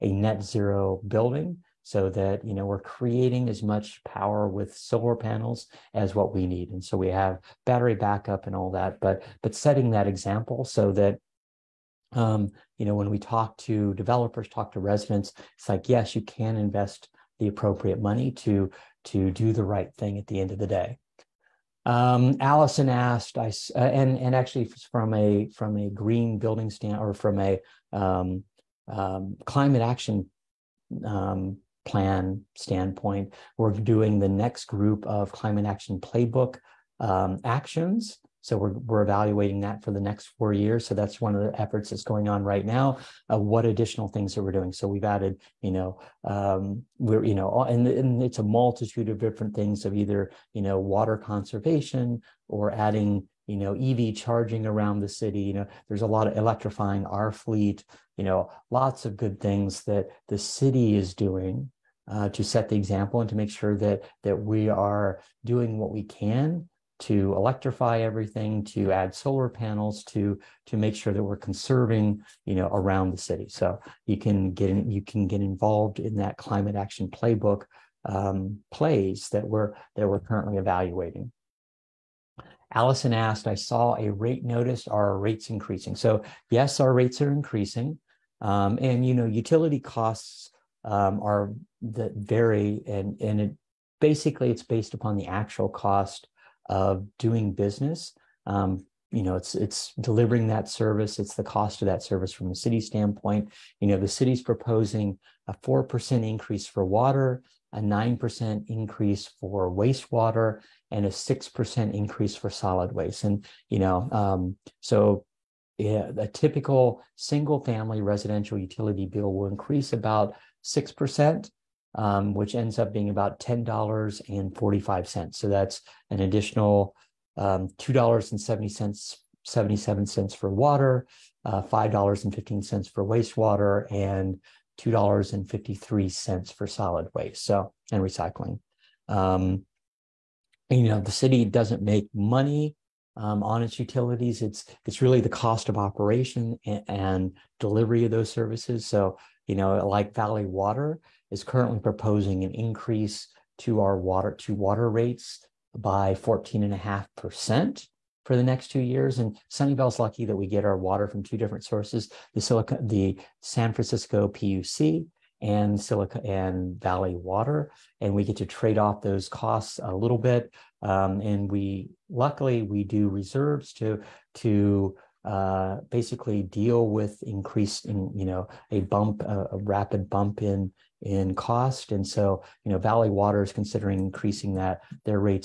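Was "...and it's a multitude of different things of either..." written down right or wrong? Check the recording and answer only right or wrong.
right.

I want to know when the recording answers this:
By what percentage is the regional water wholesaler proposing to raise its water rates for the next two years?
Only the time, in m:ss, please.
2:36.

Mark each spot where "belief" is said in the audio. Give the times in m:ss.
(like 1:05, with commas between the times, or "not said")
not said.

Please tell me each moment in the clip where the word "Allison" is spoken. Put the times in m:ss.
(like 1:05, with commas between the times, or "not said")
0:22, 1:22.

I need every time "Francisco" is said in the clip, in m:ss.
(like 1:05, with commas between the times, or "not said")
2:43.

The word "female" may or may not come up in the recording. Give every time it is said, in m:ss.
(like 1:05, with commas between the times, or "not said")
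not said.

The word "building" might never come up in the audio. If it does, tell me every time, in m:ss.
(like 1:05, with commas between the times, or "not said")
0:01, 0:26.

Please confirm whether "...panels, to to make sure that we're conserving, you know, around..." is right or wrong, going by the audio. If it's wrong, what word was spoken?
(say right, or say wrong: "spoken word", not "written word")
right.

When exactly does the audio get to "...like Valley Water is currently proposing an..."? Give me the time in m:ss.
2:29.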